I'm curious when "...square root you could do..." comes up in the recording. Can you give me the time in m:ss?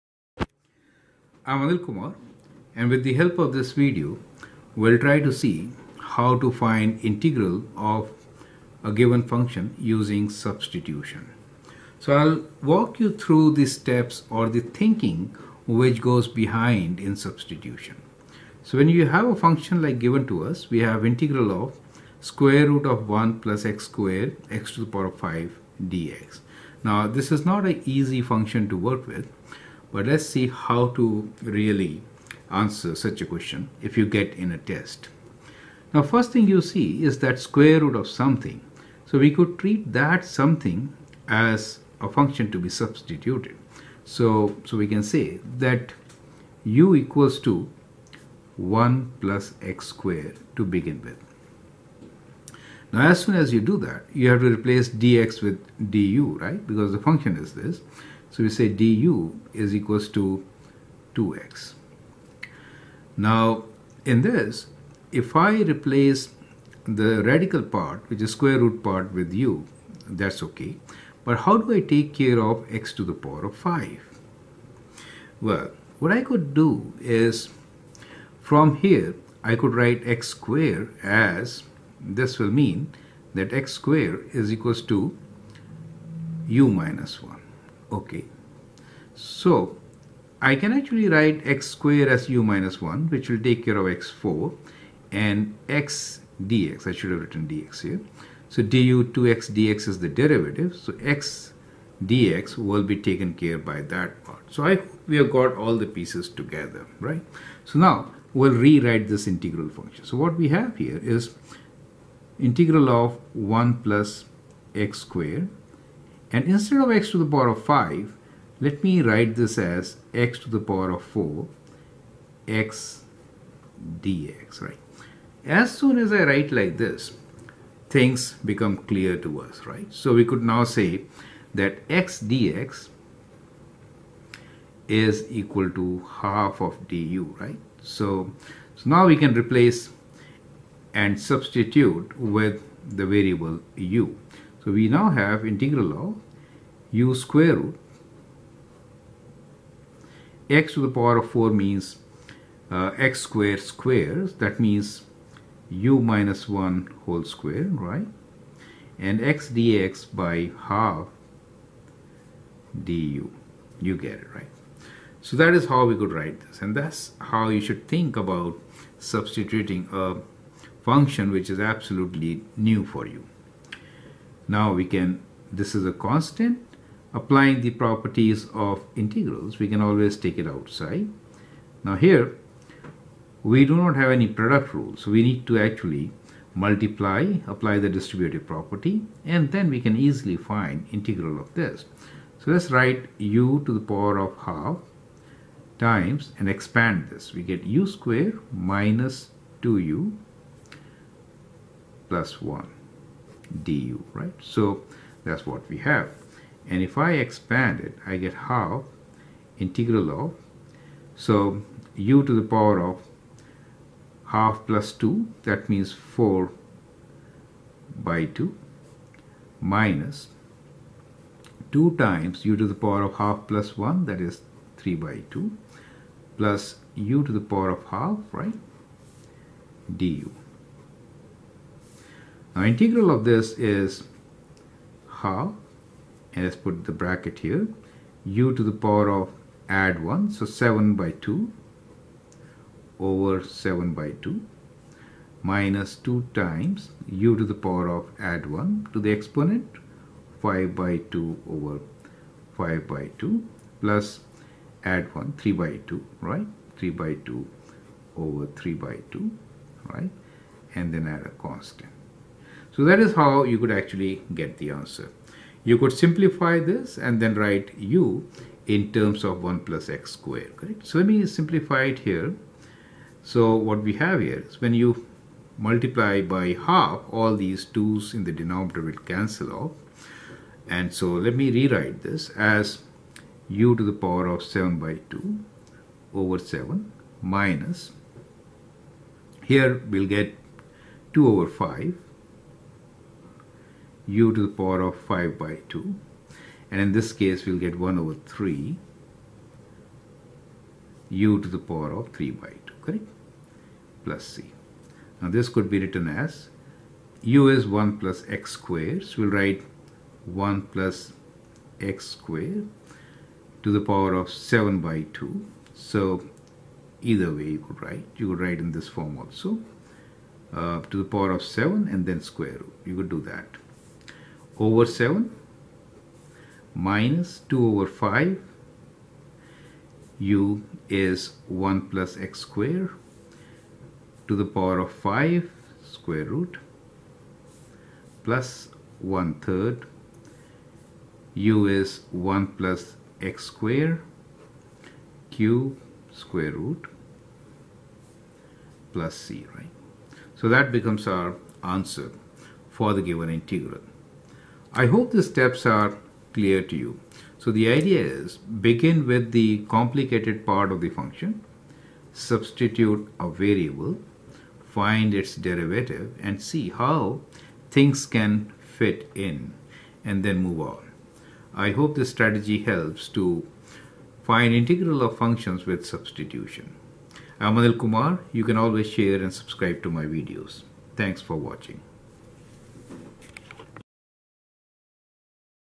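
5:22.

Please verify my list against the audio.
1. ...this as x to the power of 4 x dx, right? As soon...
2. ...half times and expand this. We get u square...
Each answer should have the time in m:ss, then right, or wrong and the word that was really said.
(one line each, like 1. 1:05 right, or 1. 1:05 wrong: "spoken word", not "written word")
1. 1:59 right
2. 3:14 right.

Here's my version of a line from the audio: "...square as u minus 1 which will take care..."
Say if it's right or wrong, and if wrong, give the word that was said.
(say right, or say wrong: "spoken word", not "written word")
right.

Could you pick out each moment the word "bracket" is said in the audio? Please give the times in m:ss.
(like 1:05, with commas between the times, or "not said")
3:56.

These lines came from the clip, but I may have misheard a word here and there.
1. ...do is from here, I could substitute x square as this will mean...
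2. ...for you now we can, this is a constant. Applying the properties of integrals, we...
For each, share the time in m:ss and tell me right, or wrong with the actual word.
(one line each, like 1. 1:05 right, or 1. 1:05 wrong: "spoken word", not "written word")
1. 1:16 wrong: "write", not "substitute"
2. 2:52 right.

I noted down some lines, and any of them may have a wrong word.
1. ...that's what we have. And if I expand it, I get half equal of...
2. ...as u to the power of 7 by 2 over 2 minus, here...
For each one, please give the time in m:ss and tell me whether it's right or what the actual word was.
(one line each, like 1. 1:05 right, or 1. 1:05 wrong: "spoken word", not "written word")
1. 3:25 wrong: "integral", not "equal"
2. 4:42 wrong: "7", not "2".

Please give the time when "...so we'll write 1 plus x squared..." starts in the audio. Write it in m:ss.
5:09.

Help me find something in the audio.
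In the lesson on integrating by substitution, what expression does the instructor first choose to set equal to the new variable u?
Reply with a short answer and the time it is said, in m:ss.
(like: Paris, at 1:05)
1 + x^2, at 0:46.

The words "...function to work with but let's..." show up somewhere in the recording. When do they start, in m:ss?
0:28.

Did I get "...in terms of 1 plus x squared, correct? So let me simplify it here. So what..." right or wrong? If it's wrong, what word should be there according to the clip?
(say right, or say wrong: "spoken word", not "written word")
right.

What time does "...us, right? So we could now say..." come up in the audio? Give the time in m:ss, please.
2:09.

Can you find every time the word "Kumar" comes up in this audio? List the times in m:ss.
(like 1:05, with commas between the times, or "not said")
0:01, 6:17.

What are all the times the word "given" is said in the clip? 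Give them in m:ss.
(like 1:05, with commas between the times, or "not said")
0:08, 0:19, 5:53.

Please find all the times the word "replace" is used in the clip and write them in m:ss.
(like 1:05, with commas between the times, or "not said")
0:54, 1:05, 2:19.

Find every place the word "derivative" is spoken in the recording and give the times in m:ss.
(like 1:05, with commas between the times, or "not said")
1:40, 6:05.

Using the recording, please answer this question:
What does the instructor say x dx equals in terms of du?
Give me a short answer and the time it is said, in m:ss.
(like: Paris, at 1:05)
half of du, at 2:16.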